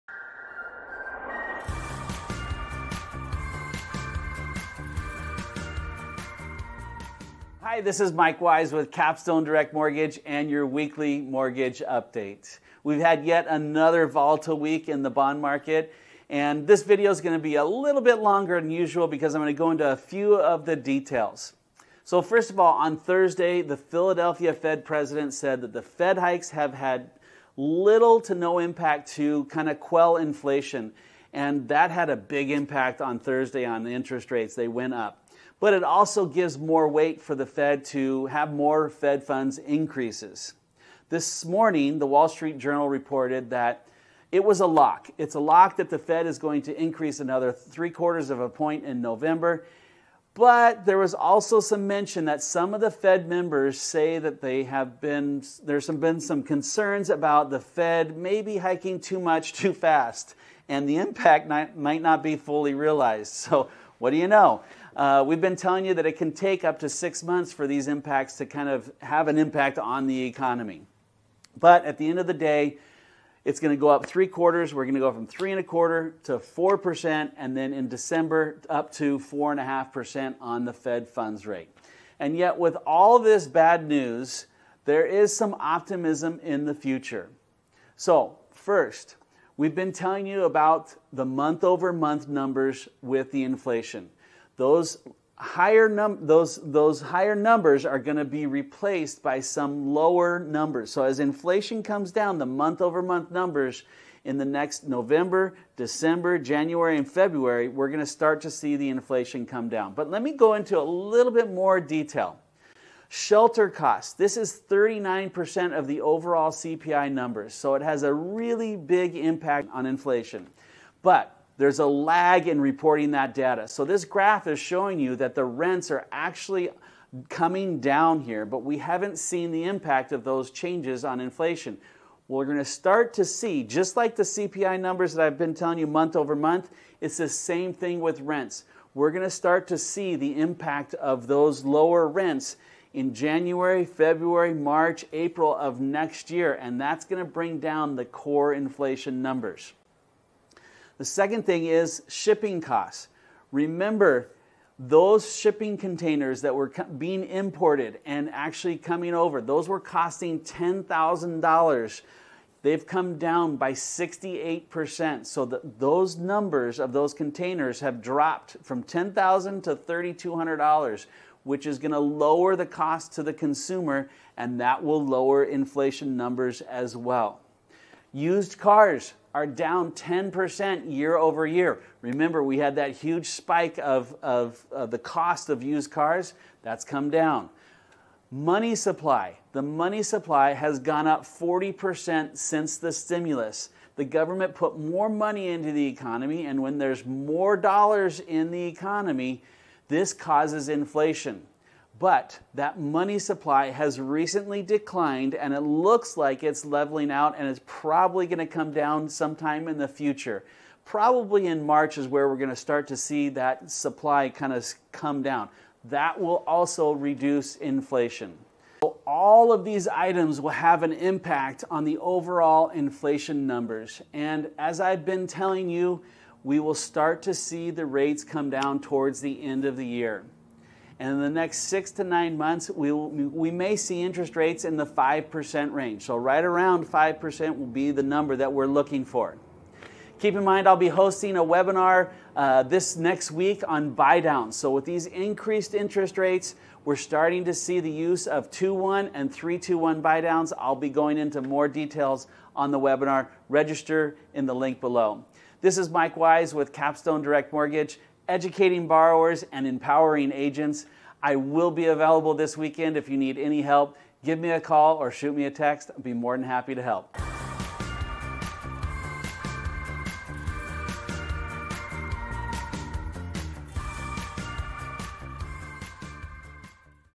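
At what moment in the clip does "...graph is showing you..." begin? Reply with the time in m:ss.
2:04.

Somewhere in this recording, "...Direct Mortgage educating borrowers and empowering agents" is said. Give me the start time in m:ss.
4:17.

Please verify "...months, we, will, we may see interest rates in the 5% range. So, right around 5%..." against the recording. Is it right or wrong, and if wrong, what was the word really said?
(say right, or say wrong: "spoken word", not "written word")
right.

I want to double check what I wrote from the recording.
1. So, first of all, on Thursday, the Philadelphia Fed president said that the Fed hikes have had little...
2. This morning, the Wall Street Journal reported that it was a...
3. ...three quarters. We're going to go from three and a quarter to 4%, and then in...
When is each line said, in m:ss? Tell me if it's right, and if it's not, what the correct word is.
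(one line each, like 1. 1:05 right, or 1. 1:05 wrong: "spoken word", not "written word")
1. 0:22 right
2. 0:41 right
3. 1:14 right.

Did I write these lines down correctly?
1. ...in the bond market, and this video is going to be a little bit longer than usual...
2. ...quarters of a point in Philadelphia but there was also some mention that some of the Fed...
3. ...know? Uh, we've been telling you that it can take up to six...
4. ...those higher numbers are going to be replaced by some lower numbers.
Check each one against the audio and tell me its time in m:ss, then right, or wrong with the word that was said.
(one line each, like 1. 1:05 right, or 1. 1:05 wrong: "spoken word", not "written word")
1. 0:14 right
2. 0:47 wrong: "November", not "Philadelphia"
3. 1:04 right
4. 1:36 right.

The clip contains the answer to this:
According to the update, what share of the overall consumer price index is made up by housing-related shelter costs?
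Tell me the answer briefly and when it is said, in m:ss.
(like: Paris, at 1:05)
39%, at 1:54.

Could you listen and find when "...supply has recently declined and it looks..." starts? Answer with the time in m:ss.
3:23.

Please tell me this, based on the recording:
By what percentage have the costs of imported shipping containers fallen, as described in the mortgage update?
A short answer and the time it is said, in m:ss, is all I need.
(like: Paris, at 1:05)
68%, at 2:43.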